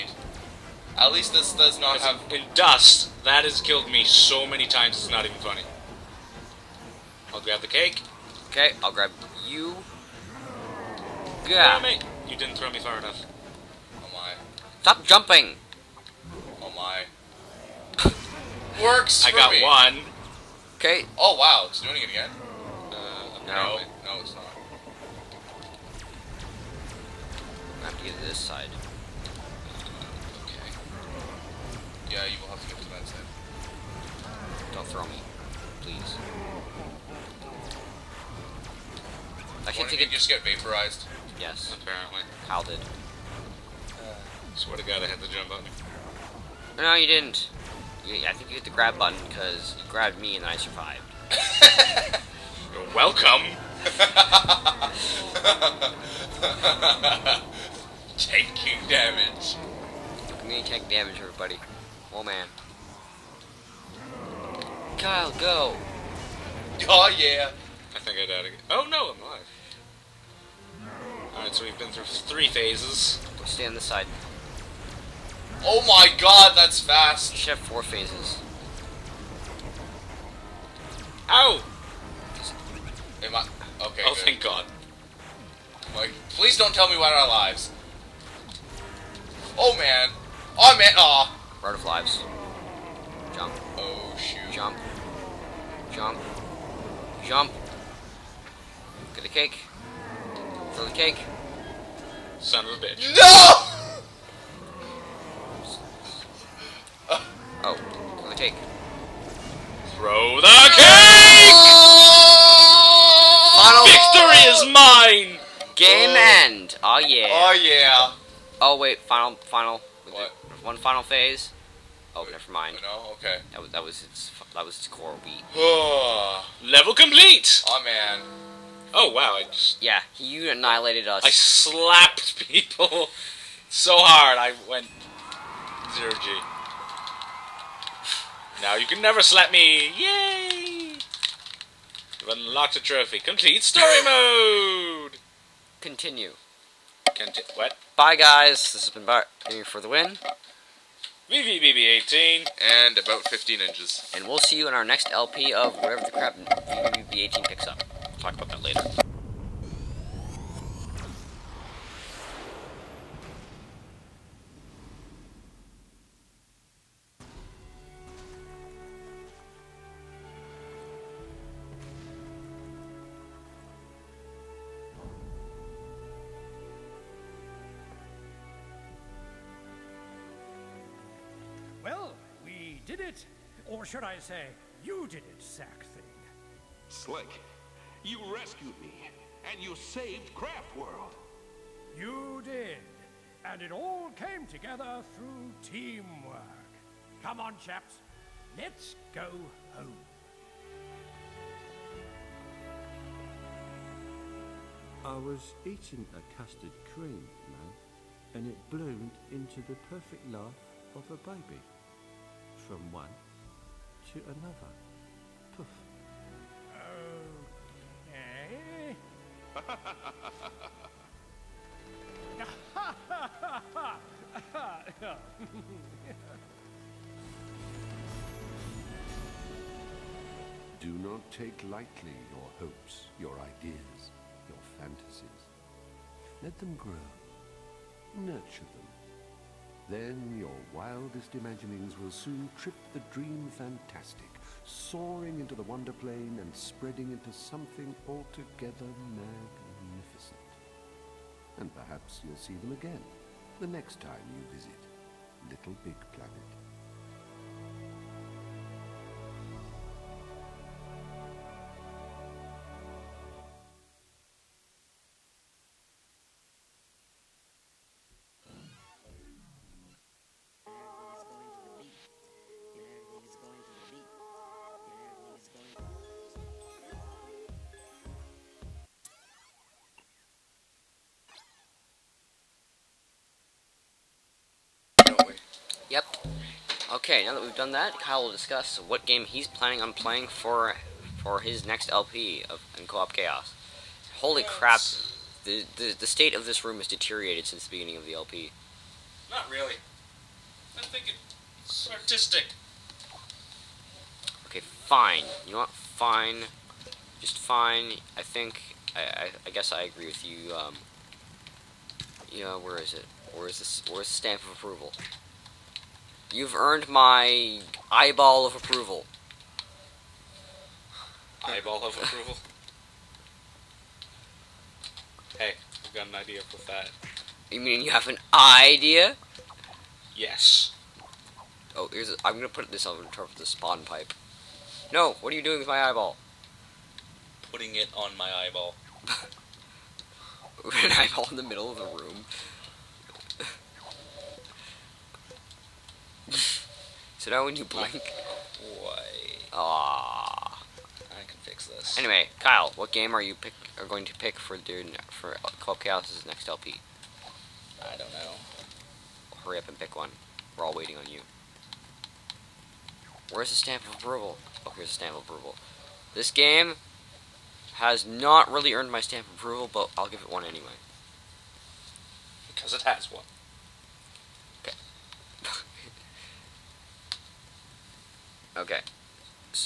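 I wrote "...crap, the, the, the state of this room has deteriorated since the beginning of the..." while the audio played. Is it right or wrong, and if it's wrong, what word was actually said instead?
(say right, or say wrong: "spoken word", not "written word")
right.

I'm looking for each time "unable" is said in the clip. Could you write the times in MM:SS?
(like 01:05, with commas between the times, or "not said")
not said.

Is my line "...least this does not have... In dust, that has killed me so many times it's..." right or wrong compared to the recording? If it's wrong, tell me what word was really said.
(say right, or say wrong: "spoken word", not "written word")
right.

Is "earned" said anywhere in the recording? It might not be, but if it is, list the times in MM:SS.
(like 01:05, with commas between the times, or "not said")
05:16, 06:08.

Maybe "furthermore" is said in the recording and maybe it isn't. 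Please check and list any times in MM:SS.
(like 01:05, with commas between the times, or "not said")
not said.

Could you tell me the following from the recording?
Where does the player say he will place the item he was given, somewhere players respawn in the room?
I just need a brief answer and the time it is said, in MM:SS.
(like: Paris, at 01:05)
On top of the spawn pipe, at 05:33.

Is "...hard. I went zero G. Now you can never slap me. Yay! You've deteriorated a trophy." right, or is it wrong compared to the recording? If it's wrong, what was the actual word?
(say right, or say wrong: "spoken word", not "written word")
wrong: "unlocked", not "deteriorated".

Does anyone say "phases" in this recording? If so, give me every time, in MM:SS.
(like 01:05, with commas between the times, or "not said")
01:12, 01:17, 02:01.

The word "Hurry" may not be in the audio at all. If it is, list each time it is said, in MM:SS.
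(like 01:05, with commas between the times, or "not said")
05:59.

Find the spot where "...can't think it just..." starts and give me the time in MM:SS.
00:39.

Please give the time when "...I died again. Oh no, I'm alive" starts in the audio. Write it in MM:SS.
01:08.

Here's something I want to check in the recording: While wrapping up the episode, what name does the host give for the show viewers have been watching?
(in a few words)
Bart here for the win.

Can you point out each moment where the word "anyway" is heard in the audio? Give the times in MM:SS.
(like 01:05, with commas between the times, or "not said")
05:51, 06:10.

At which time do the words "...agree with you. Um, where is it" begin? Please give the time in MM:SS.
05:09.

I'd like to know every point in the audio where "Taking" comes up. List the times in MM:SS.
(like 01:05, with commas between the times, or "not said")
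00:58.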